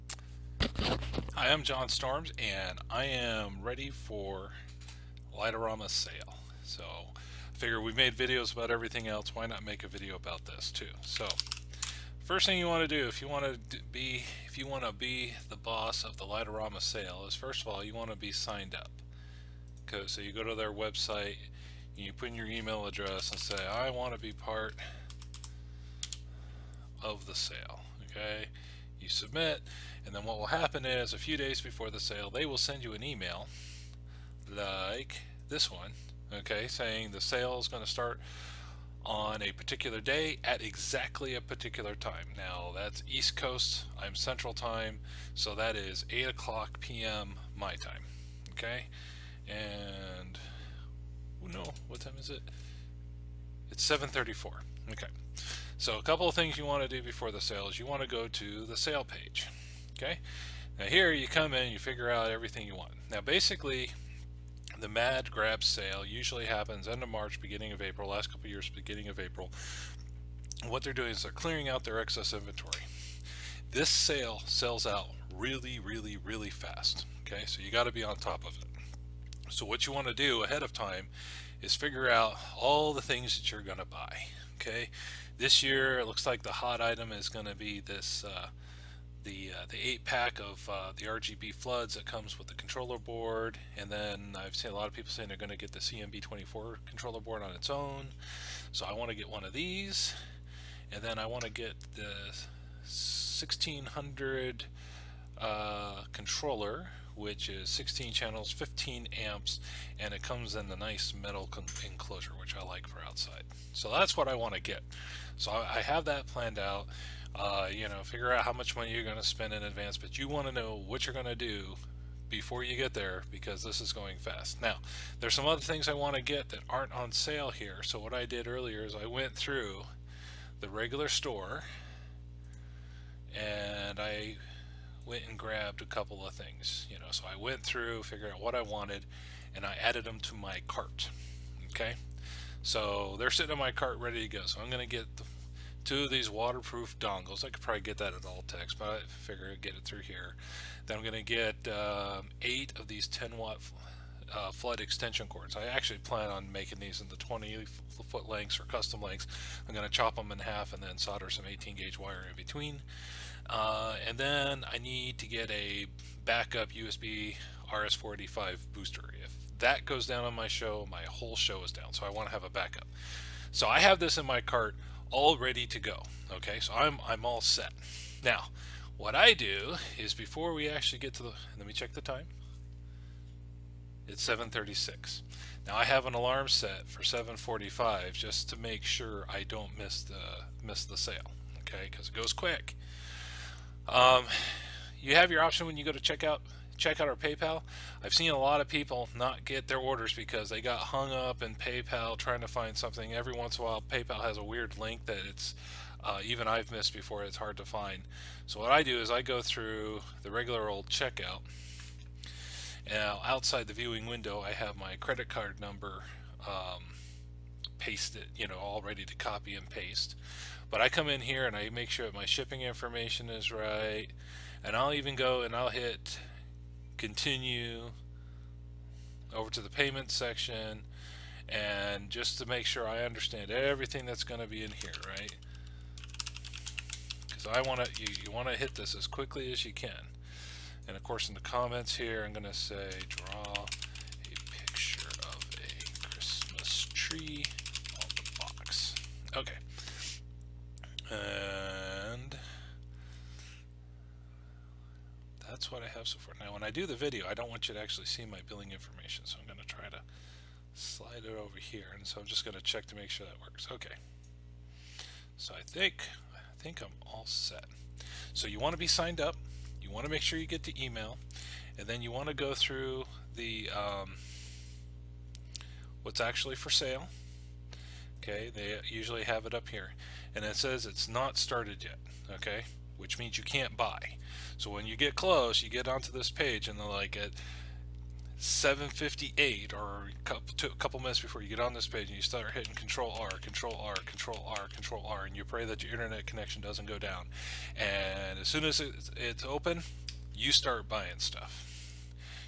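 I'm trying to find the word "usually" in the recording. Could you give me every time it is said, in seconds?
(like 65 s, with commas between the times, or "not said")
66 s, 278 s.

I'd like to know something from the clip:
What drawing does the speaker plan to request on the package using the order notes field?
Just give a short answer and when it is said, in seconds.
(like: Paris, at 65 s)
A Christmas tree, at 246 s.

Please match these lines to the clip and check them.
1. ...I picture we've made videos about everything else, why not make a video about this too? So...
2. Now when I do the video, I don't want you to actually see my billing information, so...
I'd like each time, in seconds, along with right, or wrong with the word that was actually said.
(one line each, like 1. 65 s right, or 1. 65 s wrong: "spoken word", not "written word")
1. 7 s wrong: "figure", not "picture"
2. 256 s right.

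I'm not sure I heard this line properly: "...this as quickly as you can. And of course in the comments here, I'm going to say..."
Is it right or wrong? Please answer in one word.
right.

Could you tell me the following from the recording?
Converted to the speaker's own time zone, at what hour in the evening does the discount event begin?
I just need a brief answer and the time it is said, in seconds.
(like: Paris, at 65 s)
8 p.m., at 46 s.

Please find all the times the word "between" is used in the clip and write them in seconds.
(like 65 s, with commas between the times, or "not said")
162 s.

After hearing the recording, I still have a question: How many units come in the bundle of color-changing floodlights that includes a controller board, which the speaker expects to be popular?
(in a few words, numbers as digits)
8.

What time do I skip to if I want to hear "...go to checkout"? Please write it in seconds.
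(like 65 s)
195 s.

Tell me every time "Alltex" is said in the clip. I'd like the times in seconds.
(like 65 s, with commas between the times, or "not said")
148 s.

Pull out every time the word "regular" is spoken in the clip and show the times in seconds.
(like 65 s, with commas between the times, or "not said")
130 s, 210 s.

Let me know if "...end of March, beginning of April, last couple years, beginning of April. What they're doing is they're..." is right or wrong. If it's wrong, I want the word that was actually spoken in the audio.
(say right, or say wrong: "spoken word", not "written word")
right.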